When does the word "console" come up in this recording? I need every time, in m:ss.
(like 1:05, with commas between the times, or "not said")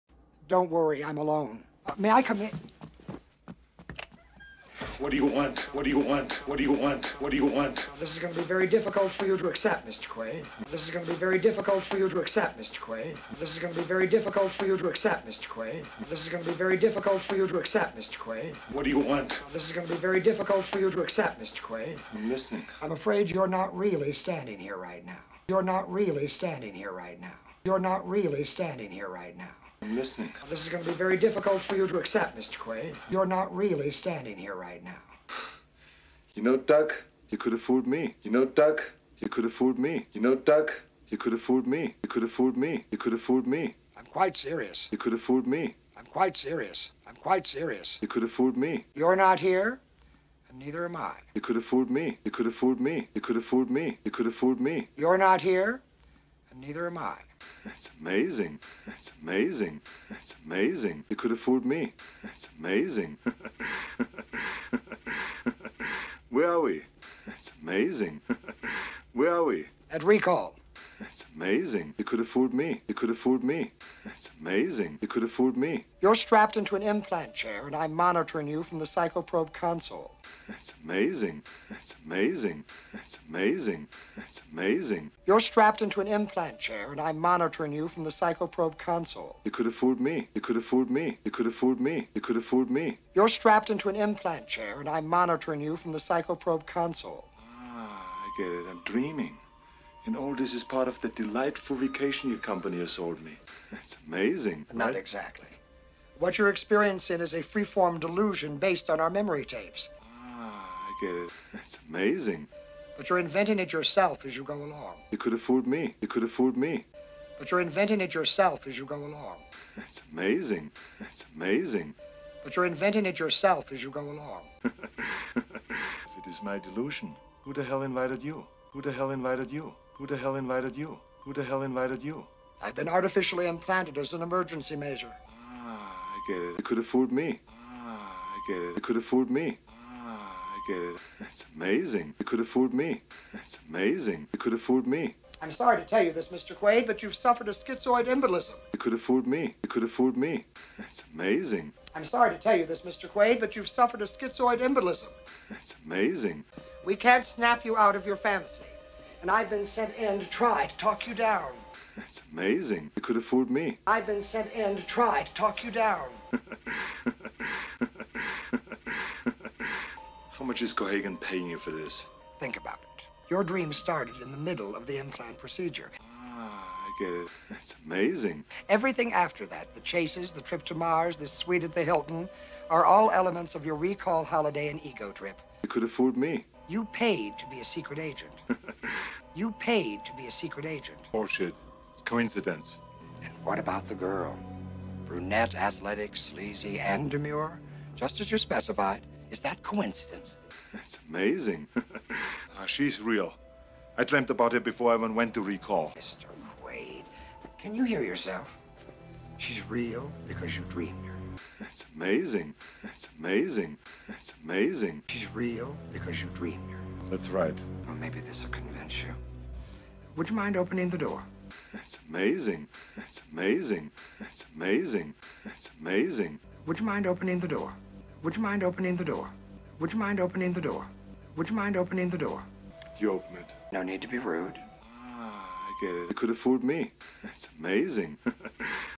1:19, 1:28, 1:36.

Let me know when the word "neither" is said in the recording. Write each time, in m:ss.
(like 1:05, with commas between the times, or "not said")
0:50, 0:56.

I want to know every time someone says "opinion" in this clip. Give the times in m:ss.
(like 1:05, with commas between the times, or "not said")
not said.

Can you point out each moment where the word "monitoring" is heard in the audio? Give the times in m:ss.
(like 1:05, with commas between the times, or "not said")
1:17, 1:27, 1:35.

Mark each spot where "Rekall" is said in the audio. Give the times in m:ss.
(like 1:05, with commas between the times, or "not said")
1:10, 3:03, 3:25.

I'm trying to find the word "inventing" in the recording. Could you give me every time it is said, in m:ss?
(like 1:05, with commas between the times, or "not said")
1:53, 1:57, 2:02.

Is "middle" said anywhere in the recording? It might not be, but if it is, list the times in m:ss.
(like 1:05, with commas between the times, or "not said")
2:54.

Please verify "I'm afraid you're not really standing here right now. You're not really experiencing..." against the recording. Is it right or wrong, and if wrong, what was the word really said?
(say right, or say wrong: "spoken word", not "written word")
wrong: "standing", not "experiencing".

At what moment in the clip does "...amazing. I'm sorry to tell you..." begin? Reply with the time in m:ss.
2:31.